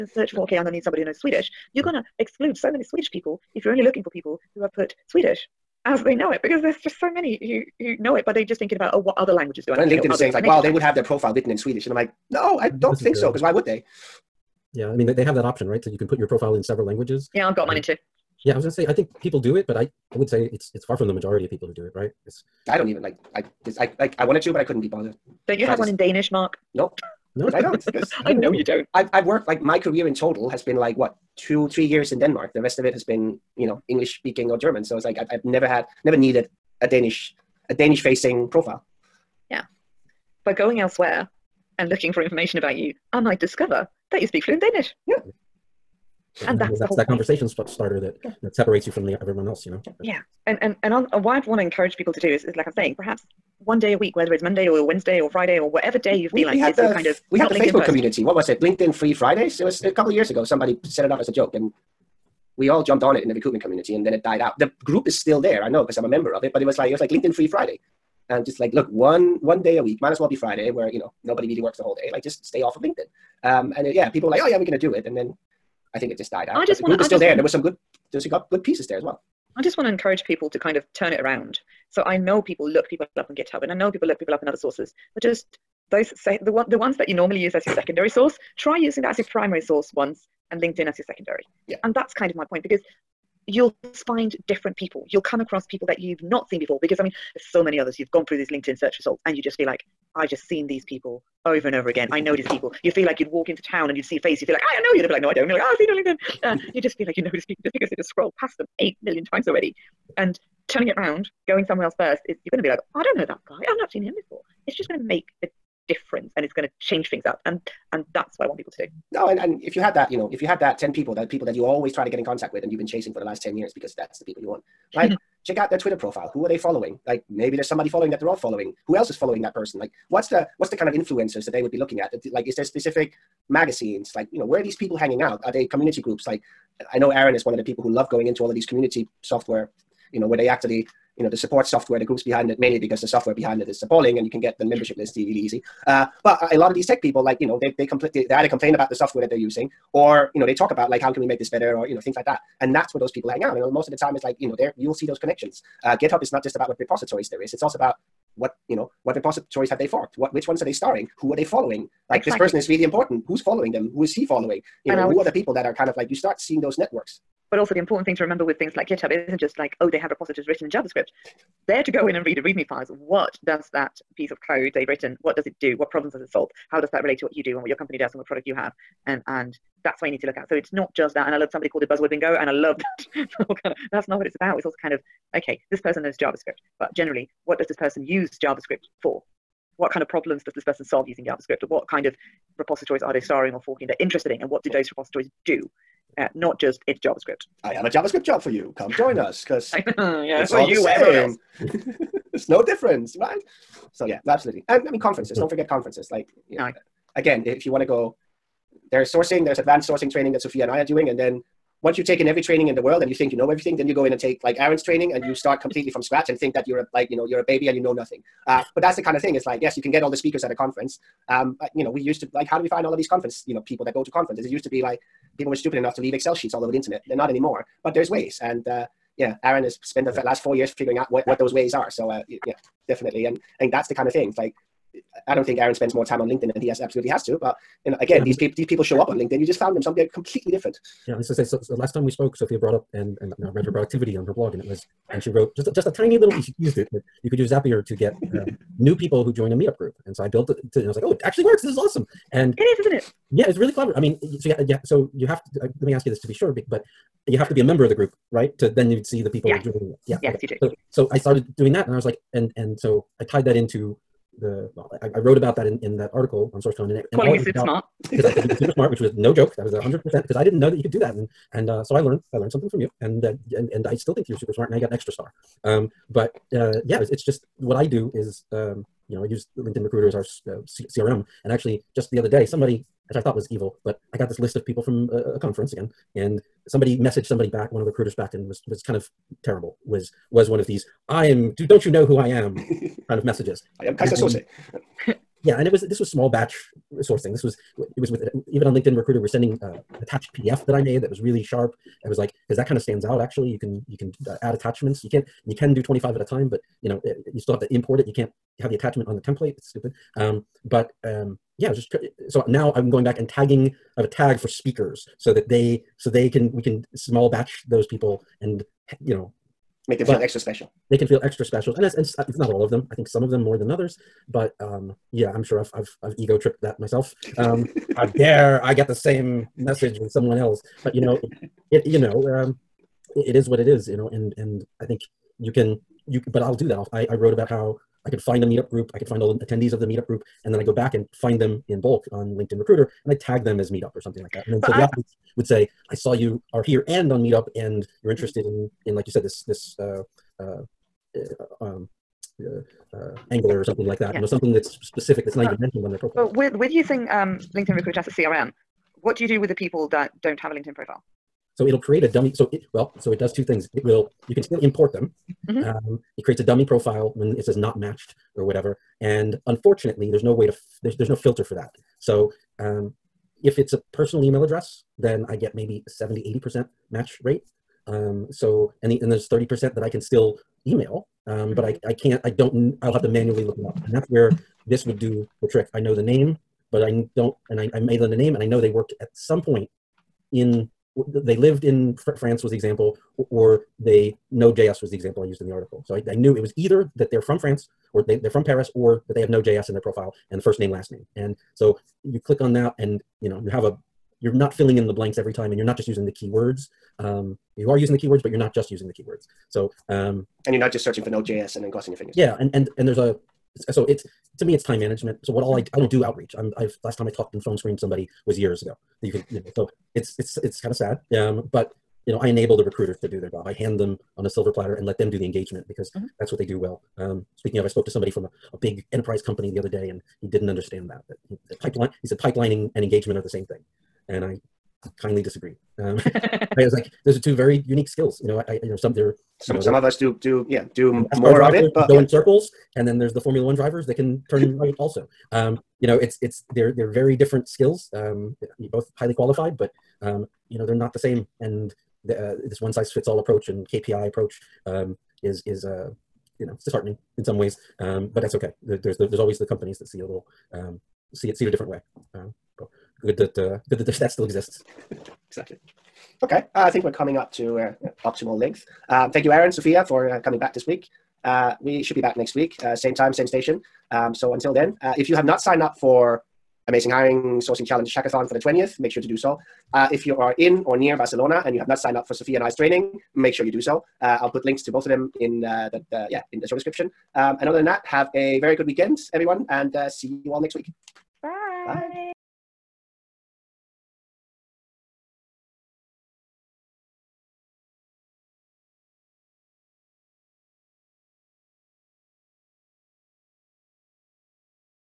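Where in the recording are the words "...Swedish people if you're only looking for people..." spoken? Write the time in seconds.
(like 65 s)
2 s.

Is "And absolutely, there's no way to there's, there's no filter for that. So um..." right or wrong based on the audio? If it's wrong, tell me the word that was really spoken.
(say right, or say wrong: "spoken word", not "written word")
wrong: "unfortunately", not "absolutely".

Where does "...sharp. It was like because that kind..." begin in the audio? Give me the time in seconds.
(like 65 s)
301 s.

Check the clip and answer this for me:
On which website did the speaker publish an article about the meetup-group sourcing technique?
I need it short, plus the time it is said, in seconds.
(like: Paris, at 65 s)
SourceCon, at 266 s.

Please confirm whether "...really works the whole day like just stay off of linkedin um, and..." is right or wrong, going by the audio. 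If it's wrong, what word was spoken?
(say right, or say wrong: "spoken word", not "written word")
right.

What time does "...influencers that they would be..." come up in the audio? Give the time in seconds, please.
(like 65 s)
130 s.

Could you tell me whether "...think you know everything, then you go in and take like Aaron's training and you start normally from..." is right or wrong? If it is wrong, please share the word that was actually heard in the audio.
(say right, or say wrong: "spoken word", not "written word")
wrong: "completely", not "normally".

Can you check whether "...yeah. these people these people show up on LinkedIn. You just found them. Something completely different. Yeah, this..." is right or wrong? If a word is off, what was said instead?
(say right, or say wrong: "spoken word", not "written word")
right.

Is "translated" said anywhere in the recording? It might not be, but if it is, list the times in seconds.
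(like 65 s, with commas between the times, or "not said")
not said.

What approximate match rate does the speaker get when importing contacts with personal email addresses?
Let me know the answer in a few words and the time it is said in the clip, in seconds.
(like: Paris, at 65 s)
70-80%, at 375 s.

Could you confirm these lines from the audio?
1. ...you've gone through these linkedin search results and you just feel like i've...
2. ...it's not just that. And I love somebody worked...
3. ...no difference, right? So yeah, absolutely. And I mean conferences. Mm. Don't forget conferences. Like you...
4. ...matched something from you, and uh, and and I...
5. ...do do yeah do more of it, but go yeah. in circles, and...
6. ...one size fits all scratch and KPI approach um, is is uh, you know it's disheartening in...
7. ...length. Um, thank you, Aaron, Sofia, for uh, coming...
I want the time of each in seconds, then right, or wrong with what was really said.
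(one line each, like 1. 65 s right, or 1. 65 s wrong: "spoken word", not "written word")
1. 97 s right
2. 180 s wrong: "called", not "worked"
3. 202 s right
4. 272 s wrong: "learned", not "matched"
5. 439 s right
6. 452 s wrong: "approach", not "scratch"
7. 468 s right.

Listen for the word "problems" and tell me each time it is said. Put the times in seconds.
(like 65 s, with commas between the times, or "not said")
175 s, 190 s.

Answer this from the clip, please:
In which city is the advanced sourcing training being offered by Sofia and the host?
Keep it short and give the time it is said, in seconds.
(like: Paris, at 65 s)
Barcelona, at 480 s.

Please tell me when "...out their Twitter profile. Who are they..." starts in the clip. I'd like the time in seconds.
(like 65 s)
125 s.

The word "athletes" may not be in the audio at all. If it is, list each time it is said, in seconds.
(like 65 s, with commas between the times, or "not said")
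344 s.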